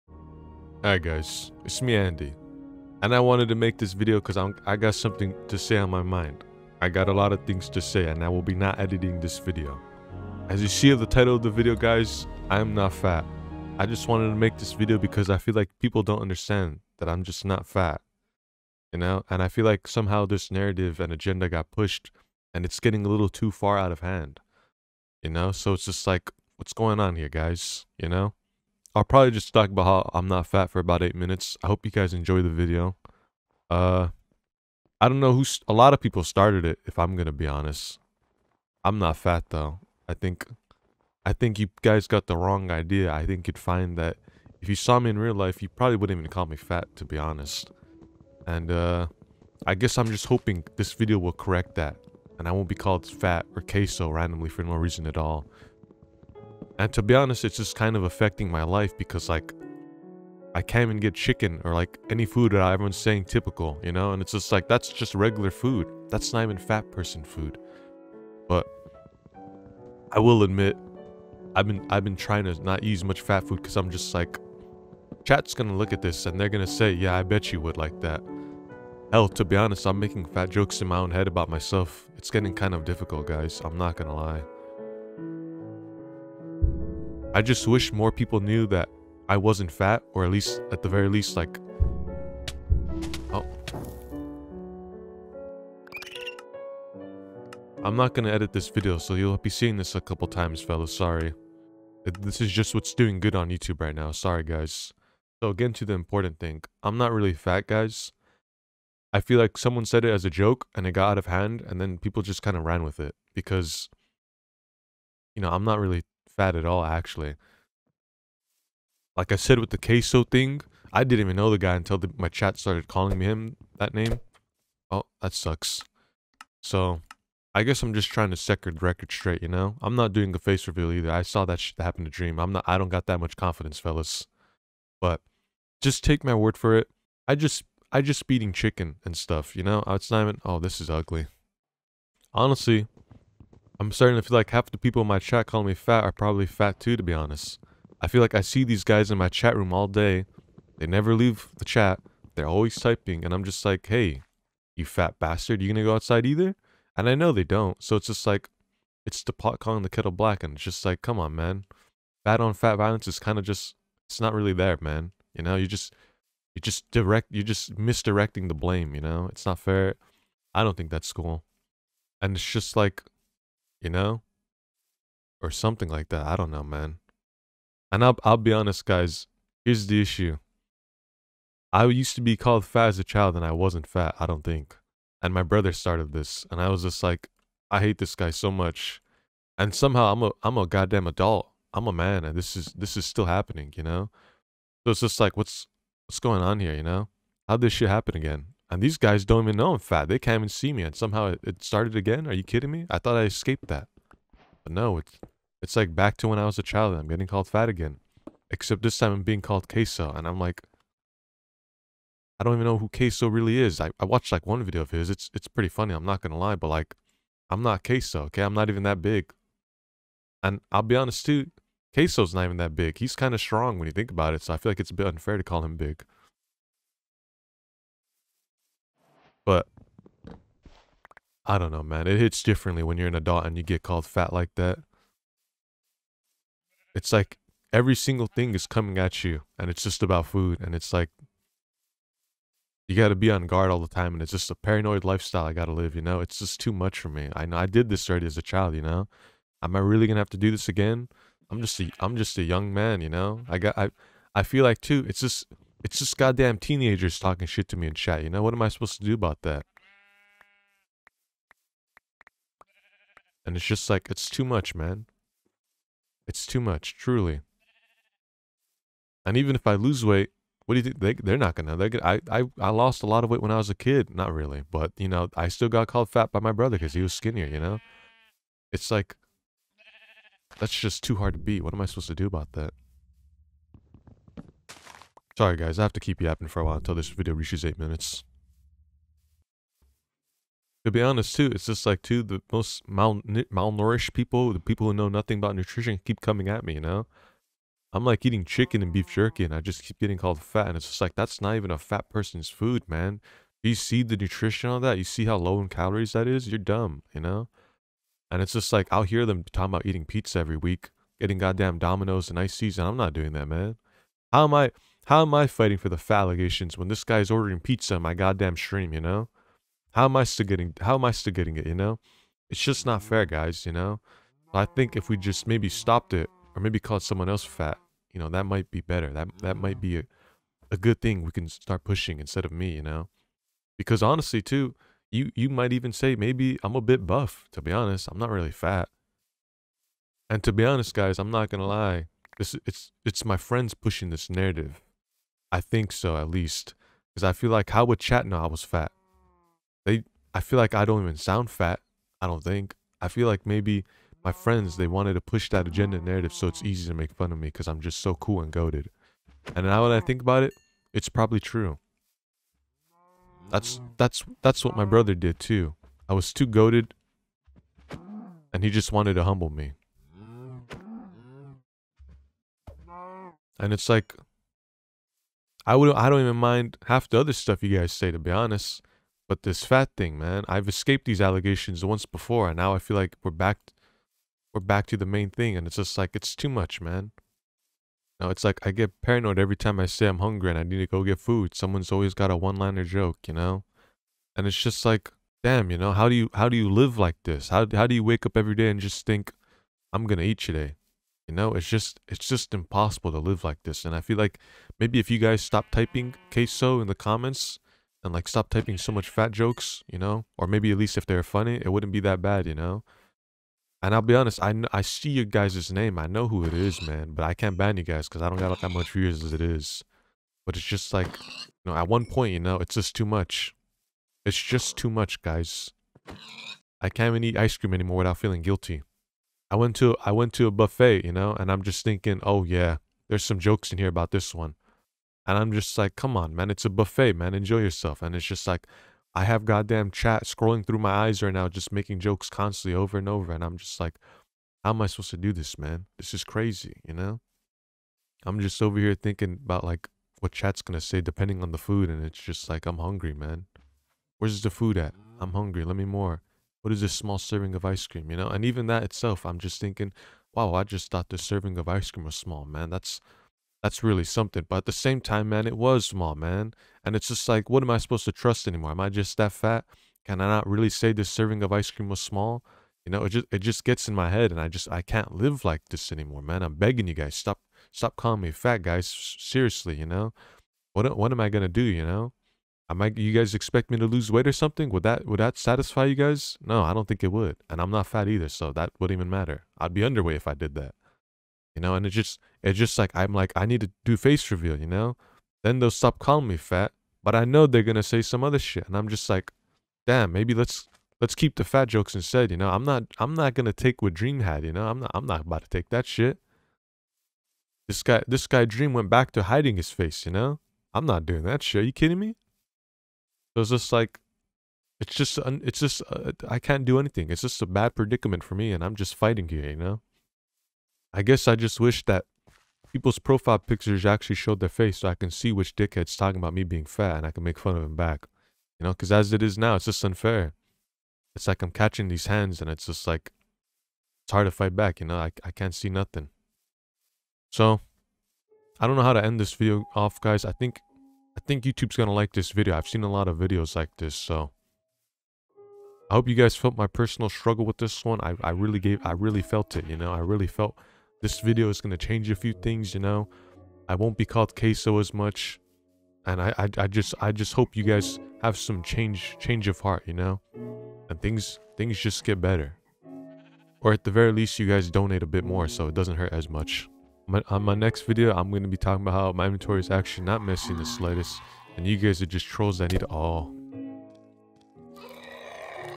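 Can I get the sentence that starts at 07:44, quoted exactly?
But at the same time, man, it was small, man.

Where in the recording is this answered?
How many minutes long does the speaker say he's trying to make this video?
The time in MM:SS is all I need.
04:47.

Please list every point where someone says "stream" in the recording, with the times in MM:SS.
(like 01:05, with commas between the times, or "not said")
05:18.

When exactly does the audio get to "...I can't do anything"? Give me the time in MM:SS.
08:36.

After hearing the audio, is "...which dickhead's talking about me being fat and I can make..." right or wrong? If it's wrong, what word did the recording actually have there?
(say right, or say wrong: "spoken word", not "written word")
right.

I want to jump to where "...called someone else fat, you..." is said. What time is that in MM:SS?
05:26.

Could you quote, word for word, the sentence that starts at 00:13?
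I just wanted to make this video because I feel like people don't understand that I'm just not fat.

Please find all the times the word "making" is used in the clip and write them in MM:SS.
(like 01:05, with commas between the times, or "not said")
01:19, 07:21.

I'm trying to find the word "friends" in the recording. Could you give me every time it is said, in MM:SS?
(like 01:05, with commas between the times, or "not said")
05:43, 05:54.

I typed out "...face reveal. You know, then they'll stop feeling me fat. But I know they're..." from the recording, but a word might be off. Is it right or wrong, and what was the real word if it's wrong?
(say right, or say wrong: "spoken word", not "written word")
wrong: "calling", not "feeling".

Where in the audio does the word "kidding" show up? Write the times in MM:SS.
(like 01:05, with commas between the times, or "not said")
03:22, 08:31.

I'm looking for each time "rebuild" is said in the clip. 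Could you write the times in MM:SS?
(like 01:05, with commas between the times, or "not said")
not said.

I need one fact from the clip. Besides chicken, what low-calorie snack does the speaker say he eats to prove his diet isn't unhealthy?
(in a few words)
Beef jerky.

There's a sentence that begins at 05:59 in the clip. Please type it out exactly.
And now that I think about it, it's probably true.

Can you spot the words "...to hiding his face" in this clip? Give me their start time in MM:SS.
08:29.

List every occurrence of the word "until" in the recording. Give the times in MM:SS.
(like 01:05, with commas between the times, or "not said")
02:01, 04:46.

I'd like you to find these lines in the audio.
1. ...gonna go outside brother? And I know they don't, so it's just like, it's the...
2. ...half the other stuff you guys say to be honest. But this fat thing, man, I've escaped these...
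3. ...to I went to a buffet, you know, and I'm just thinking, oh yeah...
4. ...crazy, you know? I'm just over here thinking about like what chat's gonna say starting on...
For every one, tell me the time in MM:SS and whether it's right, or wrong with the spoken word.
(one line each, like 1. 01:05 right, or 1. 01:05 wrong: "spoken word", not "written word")
1. 02:35 wrong: "either", not "brother"
2. 06:16 right
3. 07:09 right
4. 07:26 wrong: "depending", not "starting".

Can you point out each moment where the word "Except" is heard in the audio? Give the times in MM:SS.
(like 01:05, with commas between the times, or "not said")
03:28.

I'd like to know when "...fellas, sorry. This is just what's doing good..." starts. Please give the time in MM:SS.
01:40.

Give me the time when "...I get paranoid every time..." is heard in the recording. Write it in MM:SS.
06:28.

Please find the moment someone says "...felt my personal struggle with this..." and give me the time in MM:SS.
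09:06.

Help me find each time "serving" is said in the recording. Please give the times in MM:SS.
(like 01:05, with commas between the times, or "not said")
07:37, 07:41, 07:51.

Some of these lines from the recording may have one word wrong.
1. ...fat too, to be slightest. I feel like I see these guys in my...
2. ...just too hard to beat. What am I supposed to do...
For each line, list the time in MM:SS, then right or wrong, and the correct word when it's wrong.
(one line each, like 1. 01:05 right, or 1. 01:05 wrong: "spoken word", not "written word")
1. 02:26 wrong: "honest", not "slightest"
2. 04:40 right.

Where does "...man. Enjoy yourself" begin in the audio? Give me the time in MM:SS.
07:17.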